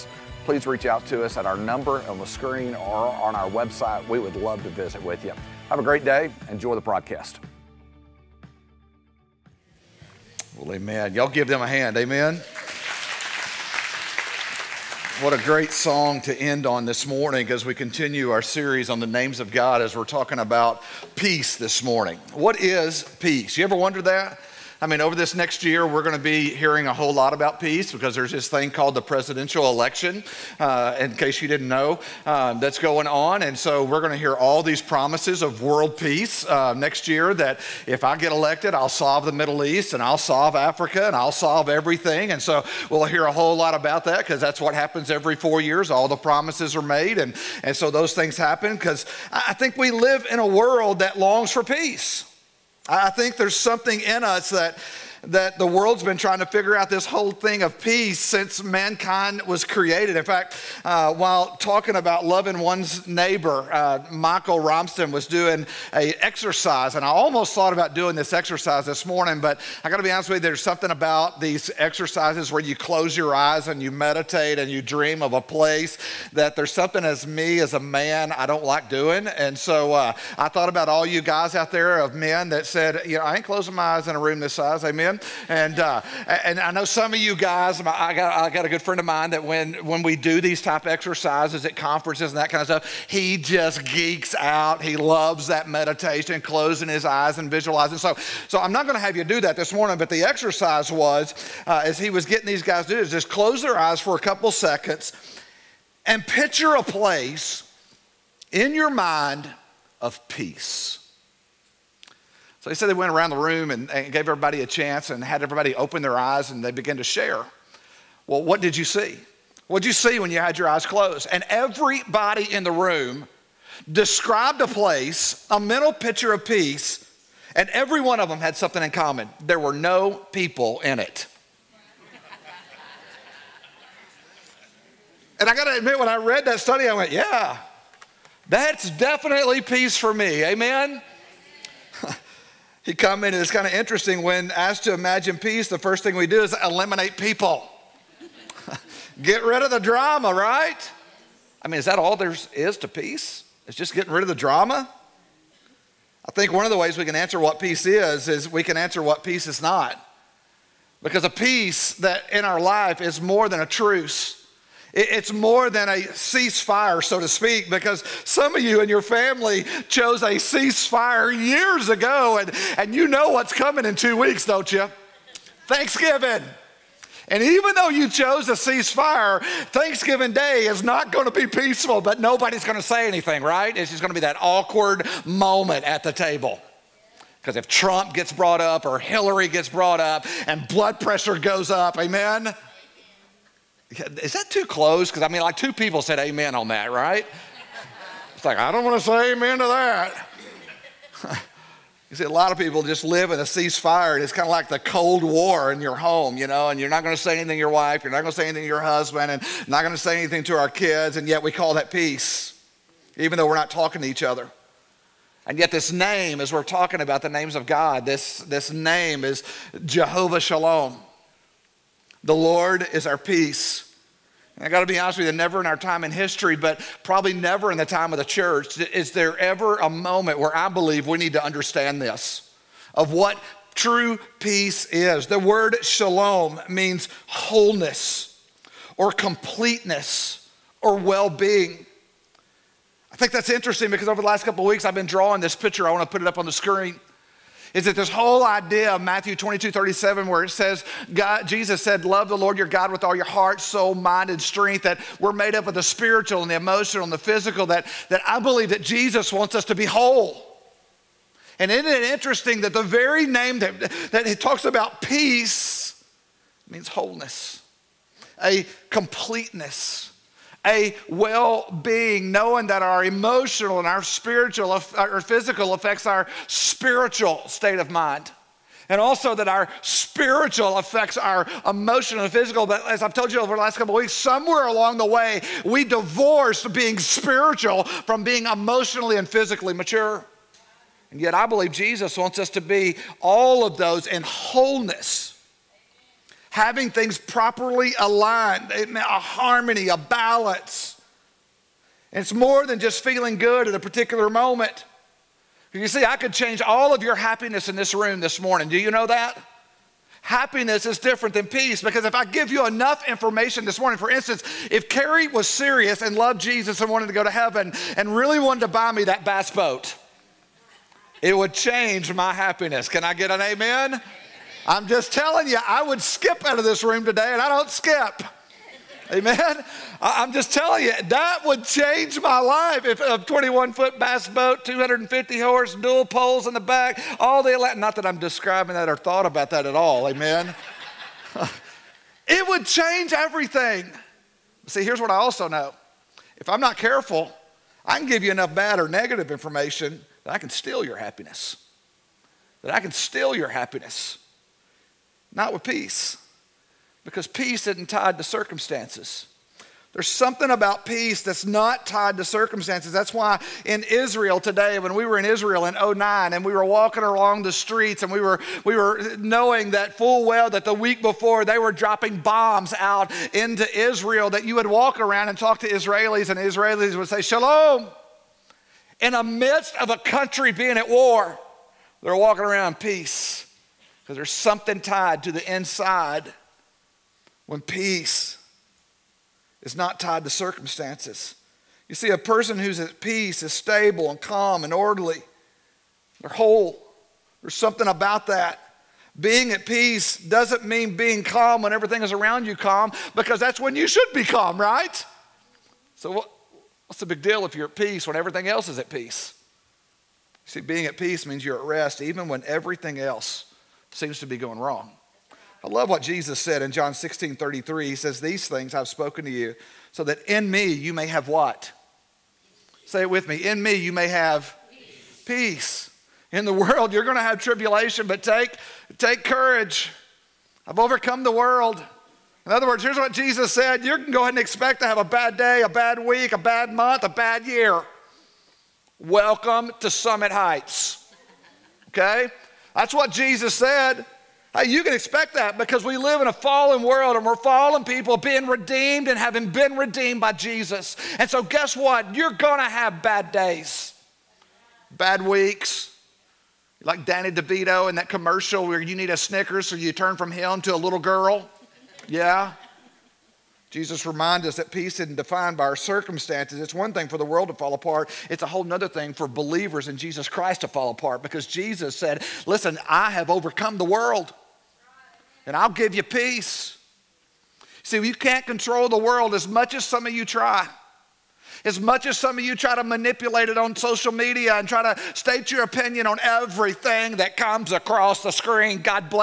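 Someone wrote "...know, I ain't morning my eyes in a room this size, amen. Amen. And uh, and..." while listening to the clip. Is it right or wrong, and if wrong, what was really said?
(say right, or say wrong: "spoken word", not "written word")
wrong: "closing", not "morning".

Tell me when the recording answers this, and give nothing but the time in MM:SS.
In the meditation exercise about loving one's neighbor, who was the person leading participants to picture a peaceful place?
01:04.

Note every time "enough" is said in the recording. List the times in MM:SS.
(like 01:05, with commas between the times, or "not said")
05:12, 05:48.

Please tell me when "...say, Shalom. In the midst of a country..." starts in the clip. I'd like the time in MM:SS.
06:17.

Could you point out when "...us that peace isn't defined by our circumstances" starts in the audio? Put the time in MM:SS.
07:44.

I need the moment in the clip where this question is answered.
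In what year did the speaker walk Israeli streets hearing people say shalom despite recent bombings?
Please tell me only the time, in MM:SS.
06:05.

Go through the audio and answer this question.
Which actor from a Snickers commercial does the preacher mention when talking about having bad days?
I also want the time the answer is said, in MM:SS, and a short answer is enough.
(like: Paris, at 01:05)
Danny DeVito, at 07:37.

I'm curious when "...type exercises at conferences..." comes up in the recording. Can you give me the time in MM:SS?
01:30.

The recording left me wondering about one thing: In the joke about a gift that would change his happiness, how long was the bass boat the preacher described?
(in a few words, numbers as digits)
21 feet.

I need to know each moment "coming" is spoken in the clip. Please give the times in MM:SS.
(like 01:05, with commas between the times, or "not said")
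02:53.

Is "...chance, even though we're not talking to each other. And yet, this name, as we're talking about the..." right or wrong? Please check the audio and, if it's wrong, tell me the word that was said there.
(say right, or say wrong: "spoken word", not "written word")
wrong: "peace", not "chance".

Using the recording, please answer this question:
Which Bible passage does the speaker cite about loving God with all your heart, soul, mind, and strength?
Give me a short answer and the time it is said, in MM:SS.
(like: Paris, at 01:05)
Matthew 22:37, at 04:09.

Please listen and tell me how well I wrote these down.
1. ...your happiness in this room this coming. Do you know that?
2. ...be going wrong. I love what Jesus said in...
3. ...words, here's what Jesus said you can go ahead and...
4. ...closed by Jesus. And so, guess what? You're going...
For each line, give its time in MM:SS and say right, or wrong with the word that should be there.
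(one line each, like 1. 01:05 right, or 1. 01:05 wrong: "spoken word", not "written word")
1. 05:07 wrong: "morning", not "coming"
2. 06:54 right
3. 07:12 right
4. 07:29 wrong: "redeemed", not "closed".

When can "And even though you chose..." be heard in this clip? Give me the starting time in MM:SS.
02:57.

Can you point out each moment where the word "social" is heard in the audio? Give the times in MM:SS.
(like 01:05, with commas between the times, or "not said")
08:03.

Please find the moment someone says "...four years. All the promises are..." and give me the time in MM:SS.
00:45.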